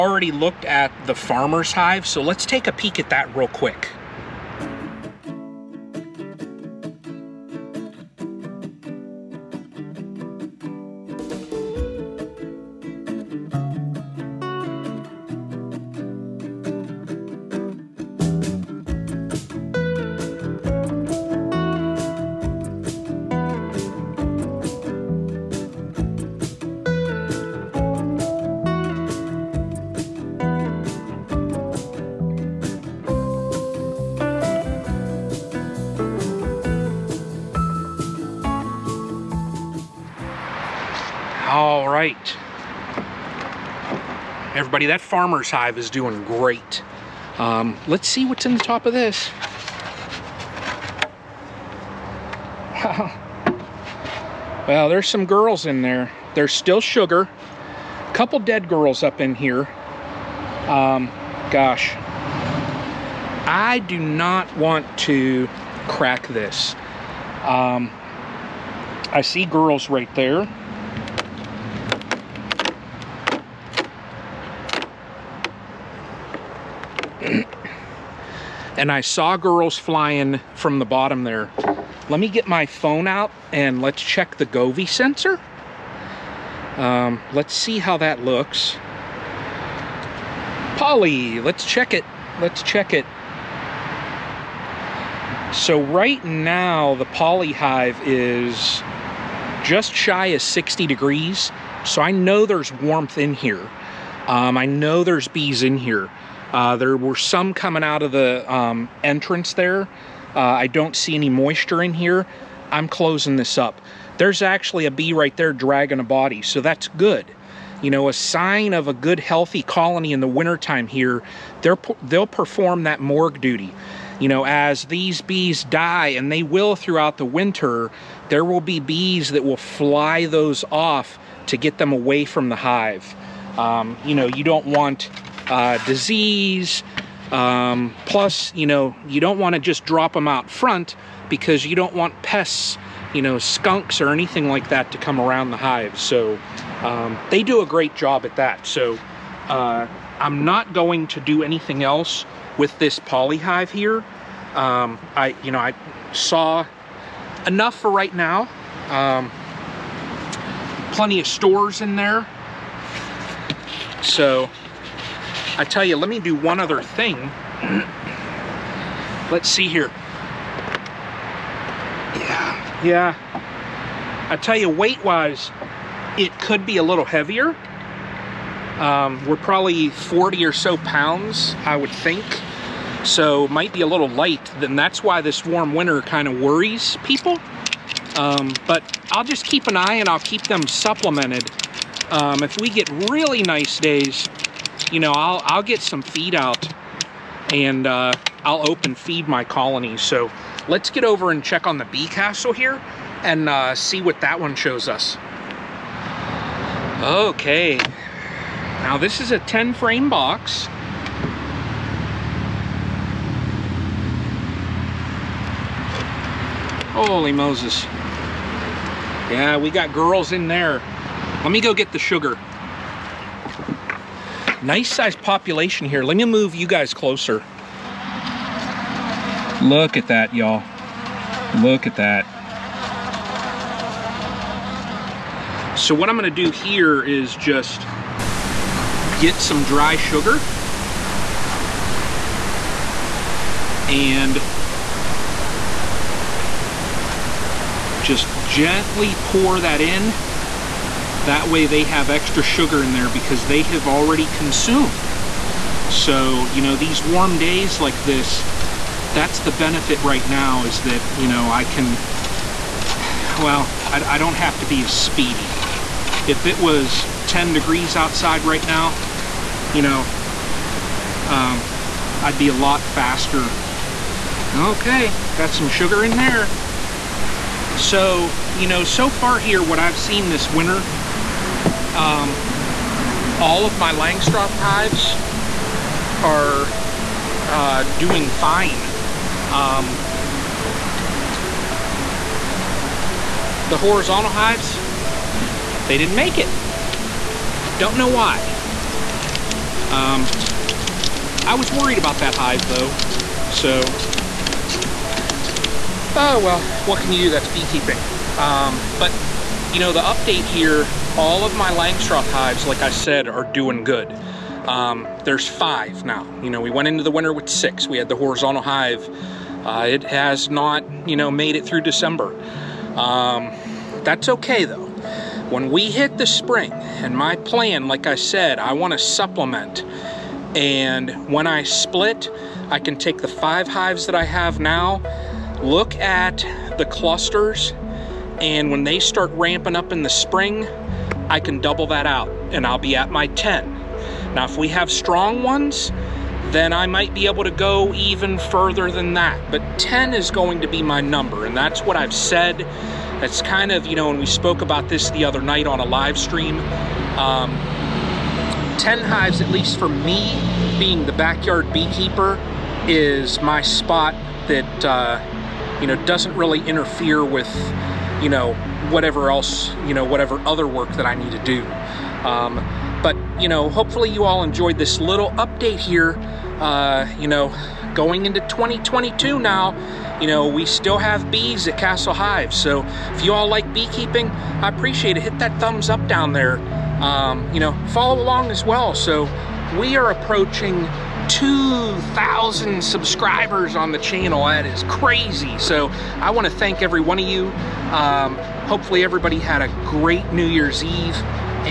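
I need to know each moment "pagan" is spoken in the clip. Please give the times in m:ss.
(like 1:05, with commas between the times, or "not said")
not said.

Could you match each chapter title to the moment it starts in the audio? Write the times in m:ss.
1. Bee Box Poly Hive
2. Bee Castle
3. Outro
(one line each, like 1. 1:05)
1. 0:40
2. 3:26
3. 5:10.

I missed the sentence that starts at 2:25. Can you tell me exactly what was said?
So um, they do a great job at that.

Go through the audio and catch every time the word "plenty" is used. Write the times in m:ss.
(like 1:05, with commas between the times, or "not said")
2:40.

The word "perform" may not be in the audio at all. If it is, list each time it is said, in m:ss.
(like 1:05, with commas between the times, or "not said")
2:02.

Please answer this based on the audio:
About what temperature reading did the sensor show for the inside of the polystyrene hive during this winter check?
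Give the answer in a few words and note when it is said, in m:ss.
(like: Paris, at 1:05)
just shy of 60 degrees, at 1:39.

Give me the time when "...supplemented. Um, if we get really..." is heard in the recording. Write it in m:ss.
3:10.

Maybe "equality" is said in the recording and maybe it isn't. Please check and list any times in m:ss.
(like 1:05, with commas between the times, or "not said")
not said.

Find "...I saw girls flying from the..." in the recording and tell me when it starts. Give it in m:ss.
1:18.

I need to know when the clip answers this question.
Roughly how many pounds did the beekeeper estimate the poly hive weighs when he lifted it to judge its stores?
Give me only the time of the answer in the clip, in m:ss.
2:59.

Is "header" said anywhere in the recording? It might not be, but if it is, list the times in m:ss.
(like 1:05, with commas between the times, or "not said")
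not said.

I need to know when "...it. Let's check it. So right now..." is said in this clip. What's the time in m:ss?
1:31.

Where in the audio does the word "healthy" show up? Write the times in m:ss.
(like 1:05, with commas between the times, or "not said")
1:59.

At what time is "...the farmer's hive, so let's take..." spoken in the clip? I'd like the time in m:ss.
0:01.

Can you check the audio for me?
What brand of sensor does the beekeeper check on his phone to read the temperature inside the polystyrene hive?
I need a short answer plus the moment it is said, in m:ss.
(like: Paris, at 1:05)
Govee, at 1:24.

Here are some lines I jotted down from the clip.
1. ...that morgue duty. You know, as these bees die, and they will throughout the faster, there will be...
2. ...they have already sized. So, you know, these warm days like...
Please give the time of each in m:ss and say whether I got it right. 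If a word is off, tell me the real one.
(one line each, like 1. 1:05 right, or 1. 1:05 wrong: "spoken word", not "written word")
1. 2:02 wrong: "winter", not "faster"
2. 4:13 wrong: "consumed", not "sized".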